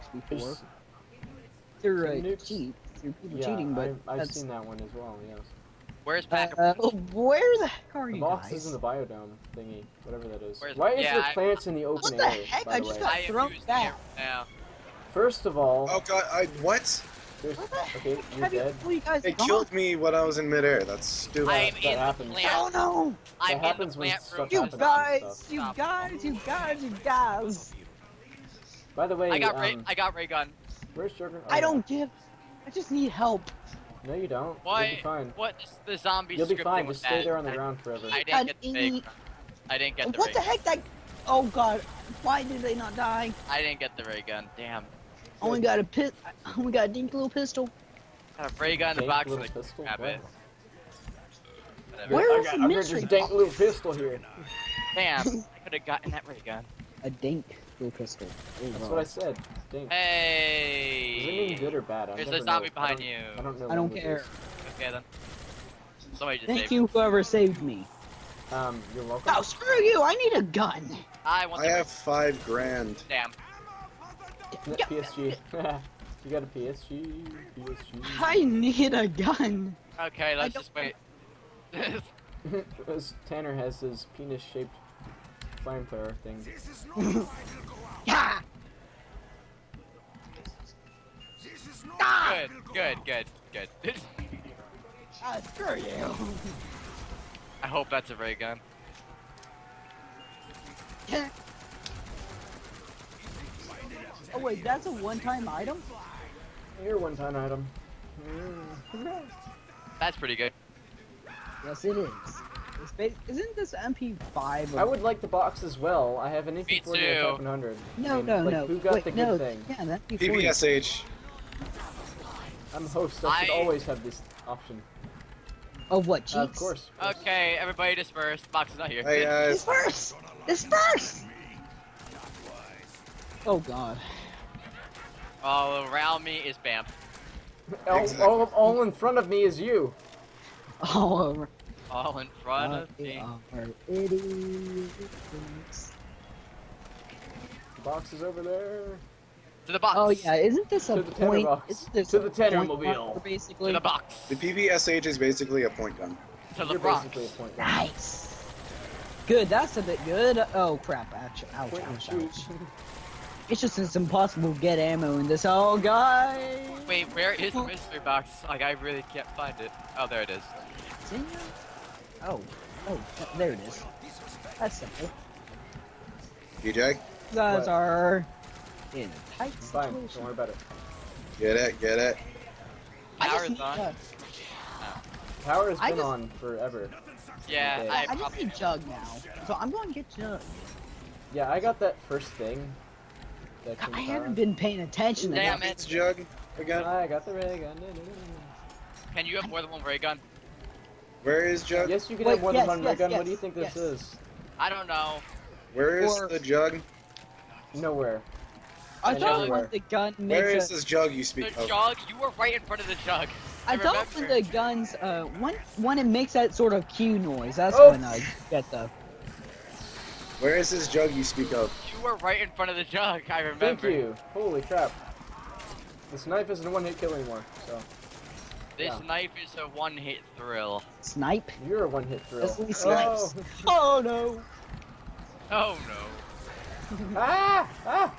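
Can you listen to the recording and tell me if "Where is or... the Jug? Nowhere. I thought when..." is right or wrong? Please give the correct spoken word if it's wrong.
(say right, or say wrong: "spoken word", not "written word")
right.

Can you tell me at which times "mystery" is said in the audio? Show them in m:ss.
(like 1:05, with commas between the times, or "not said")
0:52, 2:47.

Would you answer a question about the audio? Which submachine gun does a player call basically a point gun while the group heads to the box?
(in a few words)
PPSH.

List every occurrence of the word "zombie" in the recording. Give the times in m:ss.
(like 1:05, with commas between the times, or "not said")
0:35, 1:02.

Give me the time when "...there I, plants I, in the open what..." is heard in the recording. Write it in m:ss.
0:11.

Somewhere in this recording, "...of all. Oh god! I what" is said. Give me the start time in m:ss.
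0:15.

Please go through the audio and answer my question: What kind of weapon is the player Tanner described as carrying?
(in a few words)
flamethrower.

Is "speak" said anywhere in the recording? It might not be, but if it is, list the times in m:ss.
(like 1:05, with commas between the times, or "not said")
3:31, 3:41.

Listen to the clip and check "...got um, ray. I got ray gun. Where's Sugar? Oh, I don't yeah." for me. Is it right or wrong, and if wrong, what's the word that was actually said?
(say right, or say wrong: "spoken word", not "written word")
right.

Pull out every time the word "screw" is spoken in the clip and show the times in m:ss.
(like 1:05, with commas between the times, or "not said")
1:09, 1:35.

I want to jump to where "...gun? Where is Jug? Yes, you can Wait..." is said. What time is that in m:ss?
3:19.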